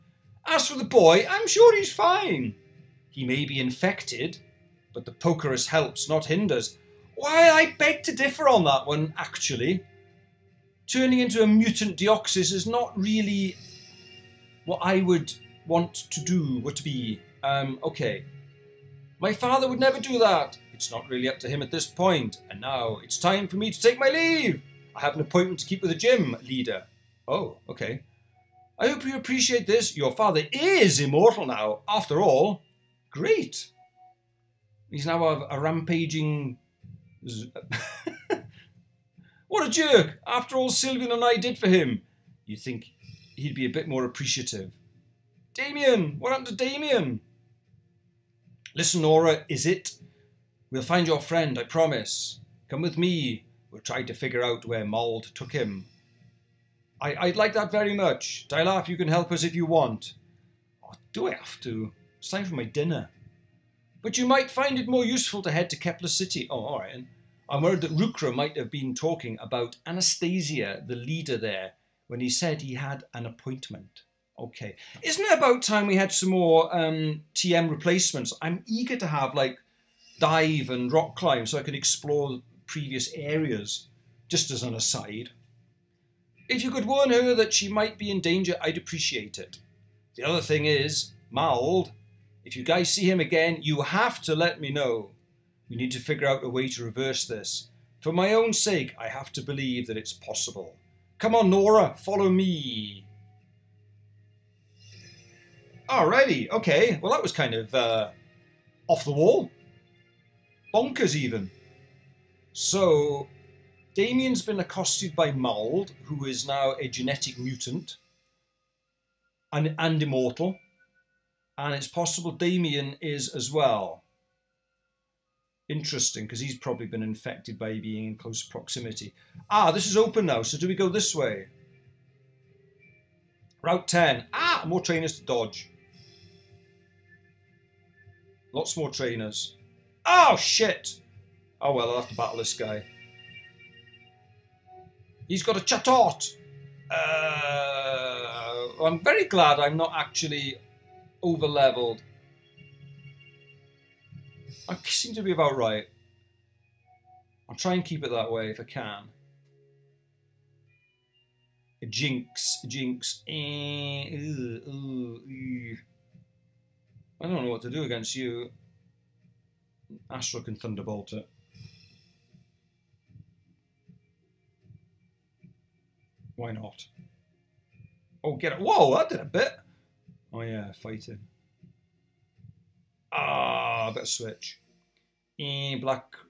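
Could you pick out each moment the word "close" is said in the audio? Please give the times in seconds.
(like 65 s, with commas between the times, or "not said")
128 s.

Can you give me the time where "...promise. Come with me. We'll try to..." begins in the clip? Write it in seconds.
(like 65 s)
51 s.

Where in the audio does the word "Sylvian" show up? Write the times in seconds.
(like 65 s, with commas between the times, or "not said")
40 s.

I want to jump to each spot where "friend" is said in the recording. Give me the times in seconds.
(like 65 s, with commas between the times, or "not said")
51 s.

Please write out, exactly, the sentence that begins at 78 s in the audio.
I'm eager to have like dive and rock climb so I can explore previous areas.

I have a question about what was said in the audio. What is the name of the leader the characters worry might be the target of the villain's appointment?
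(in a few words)
Anastasia.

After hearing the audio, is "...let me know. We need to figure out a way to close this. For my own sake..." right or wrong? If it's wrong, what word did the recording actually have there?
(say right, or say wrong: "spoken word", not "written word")
wrong: "reverse", not "close".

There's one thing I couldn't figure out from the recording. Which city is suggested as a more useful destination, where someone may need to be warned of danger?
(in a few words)
Kepler City.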